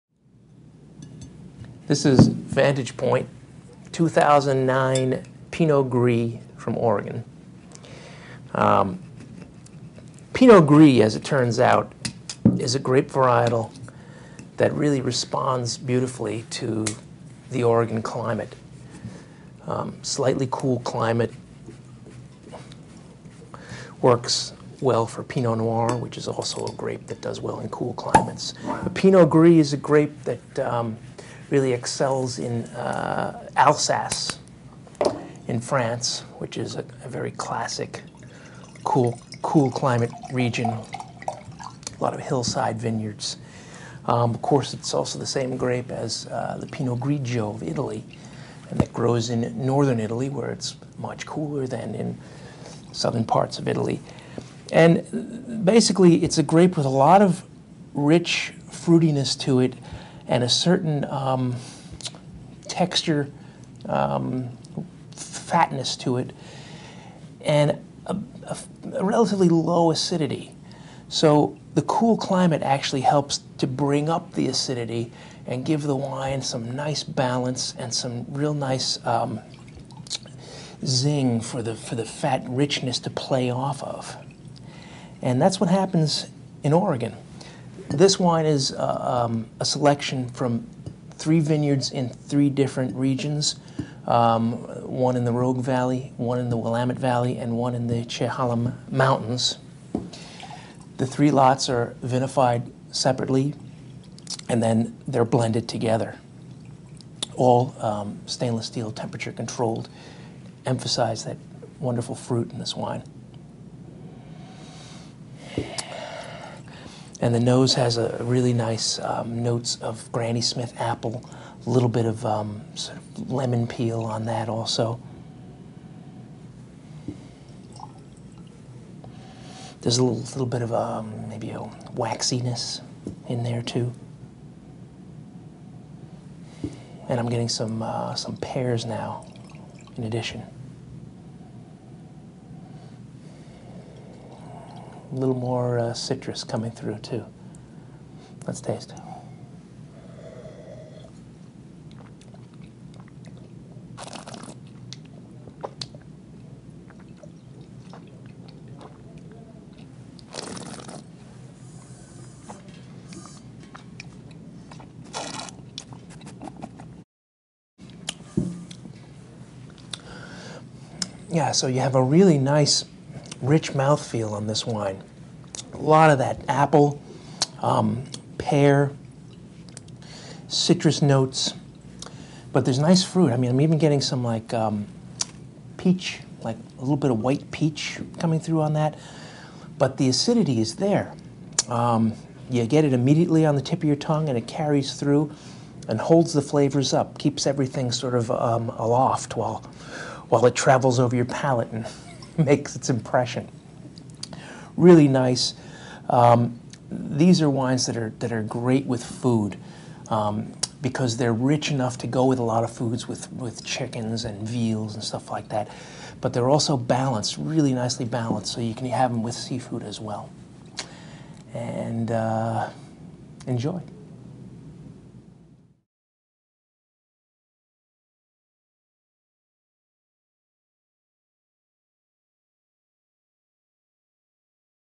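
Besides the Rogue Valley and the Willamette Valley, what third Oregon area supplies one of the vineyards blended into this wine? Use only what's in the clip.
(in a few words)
Chehalem Mountains.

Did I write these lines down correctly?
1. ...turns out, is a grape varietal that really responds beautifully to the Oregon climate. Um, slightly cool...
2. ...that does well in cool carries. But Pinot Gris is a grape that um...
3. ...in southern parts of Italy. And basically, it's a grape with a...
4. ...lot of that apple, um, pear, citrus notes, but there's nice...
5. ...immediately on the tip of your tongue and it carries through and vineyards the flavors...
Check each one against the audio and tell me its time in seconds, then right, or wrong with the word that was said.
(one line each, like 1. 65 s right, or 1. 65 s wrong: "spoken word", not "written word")
1. 11 s right
2. 27 s wrong: "climates", not "carries"
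3. 51 s right
4. 175 s right
5. 192 s wrong: "holds", not "vineyards".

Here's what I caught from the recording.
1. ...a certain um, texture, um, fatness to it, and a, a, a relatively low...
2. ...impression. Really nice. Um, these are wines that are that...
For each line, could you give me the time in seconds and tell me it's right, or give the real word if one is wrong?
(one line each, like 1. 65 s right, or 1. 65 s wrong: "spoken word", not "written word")
1. 60 s right
2. 202 s right.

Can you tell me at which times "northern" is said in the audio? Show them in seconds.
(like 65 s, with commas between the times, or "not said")
49 s.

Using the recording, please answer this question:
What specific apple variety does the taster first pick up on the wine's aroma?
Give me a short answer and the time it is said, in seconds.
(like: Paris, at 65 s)
Granny Smith, at 120 s.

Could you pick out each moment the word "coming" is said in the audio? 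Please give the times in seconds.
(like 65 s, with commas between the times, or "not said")
146 s, 188 s.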